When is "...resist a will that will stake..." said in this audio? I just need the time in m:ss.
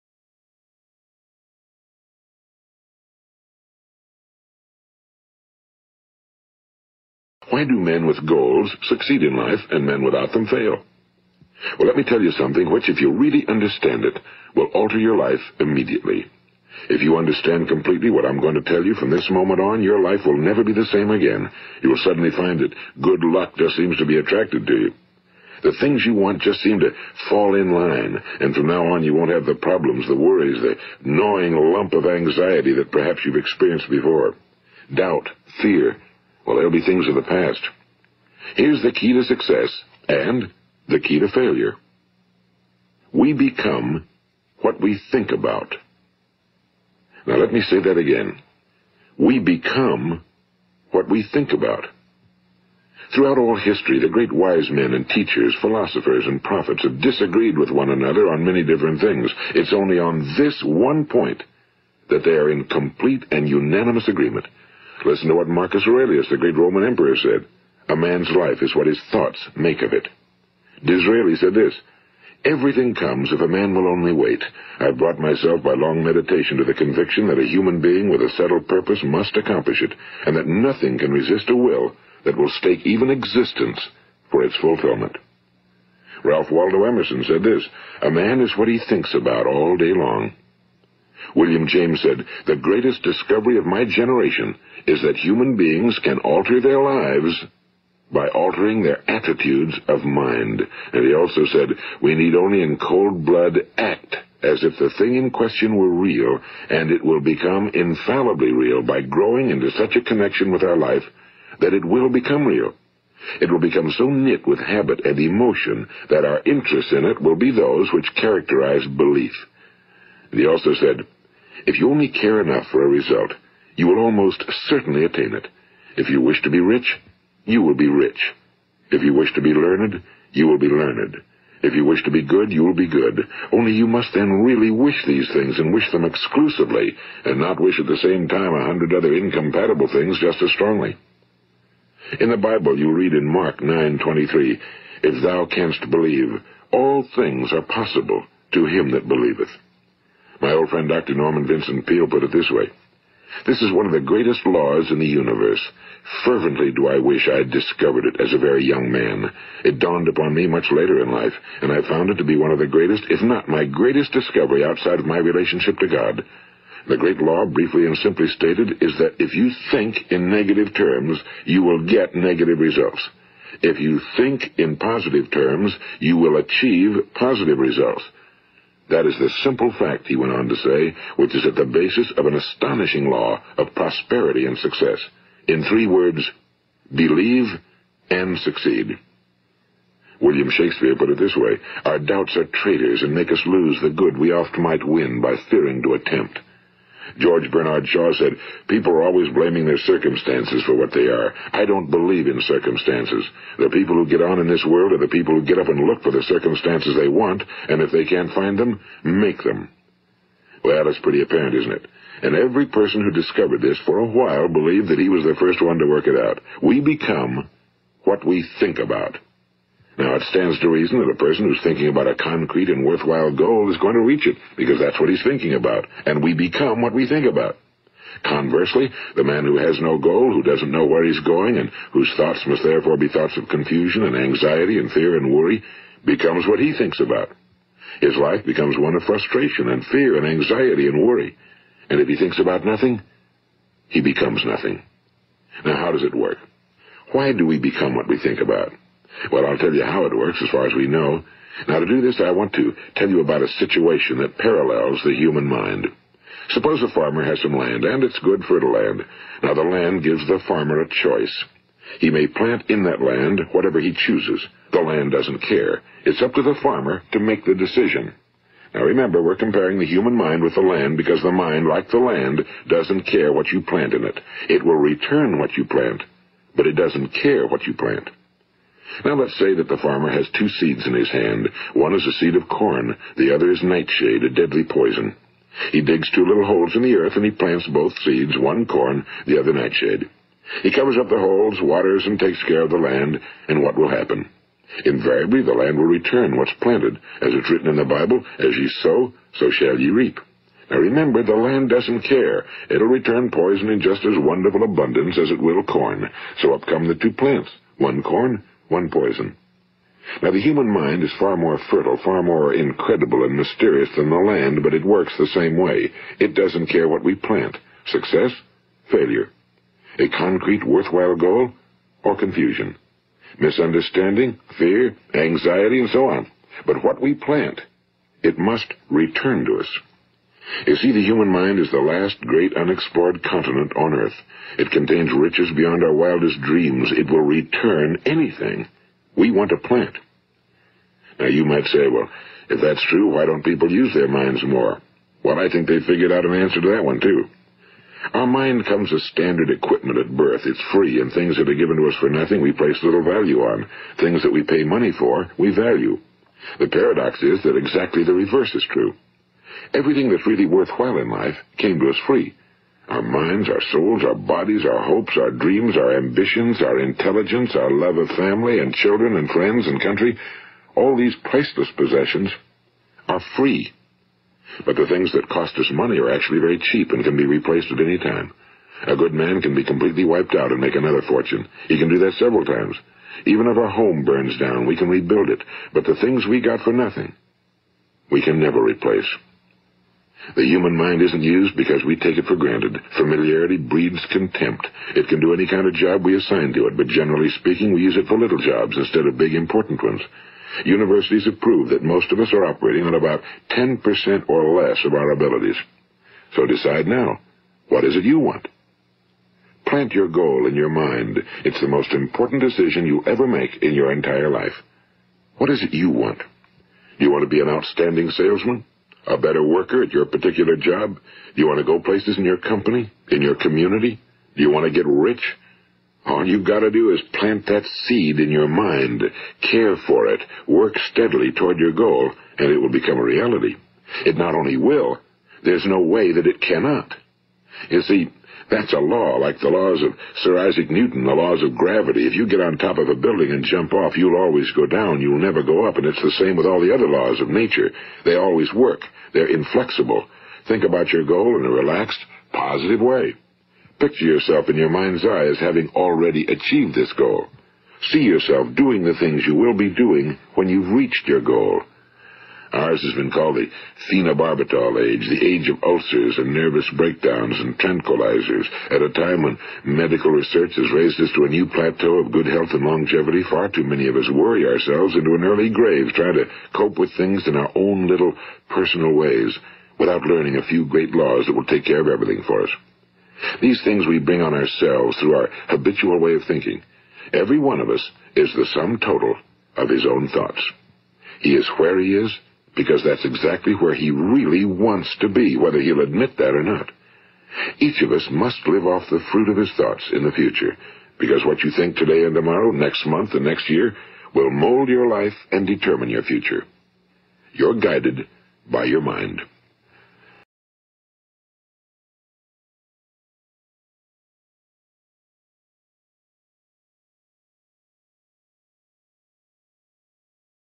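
1:21.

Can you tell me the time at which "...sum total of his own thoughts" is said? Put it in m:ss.
8:08.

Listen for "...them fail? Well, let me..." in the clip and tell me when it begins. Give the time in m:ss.
0:10.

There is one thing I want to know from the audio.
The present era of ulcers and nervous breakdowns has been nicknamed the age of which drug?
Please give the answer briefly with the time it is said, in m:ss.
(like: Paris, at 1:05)
Phenobarbital, at 7:43.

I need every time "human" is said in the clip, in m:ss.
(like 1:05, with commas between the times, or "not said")
1:17, 1:35, 4:15, 4:29, 5:10, 5:31, 6:30.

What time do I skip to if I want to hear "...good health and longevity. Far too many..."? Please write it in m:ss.
7:52.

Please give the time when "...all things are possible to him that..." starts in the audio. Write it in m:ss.
2:26.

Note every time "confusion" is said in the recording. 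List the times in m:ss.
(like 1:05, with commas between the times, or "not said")
3:53, 5:22.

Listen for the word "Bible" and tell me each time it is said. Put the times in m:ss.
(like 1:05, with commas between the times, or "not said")
2:22, 4:57.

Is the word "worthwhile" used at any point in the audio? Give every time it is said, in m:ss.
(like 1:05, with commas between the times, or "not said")
3:42, 5:20, 6:00.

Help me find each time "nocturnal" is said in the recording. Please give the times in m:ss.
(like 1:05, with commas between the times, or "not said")
not said.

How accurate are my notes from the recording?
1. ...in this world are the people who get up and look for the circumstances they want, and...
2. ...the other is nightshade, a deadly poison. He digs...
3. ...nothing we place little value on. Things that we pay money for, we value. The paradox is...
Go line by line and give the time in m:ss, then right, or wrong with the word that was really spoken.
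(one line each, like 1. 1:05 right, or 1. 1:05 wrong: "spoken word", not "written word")
1. 3:24 right
2. 4:43 right
3. 5:52 right.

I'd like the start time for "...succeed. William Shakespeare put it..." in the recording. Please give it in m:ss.
3:08.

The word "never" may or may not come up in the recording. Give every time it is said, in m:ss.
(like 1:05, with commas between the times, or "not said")
0:20, 6:28, 7:25.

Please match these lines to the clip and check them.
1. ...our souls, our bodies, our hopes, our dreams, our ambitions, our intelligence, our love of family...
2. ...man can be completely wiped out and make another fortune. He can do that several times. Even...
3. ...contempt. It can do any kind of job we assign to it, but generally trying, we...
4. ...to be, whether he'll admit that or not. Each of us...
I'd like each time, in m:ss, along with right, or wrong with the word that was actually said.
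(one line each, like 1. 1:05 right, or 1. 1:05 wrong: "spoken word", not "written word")
1. 6:03 right
2. 6:19 right
3. 6:34 wrong: "speaking", not "trying"
4. 8:15 right.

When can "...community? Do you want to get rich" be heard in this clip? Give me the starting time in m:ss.
7:03.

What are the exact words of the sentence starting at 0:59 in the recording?
It's only on this one point that they are in complete and unanimous agreement.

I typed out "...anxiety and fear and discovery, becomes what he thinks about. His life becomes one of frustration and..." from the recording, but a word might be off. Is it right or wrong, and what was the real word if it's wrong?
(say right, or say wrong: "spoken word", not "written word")
wrong: "worry", not "discovery".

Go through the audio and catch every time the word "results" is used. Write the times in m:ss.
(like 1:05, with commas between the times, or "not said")
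2:02, 2:52, 2:57.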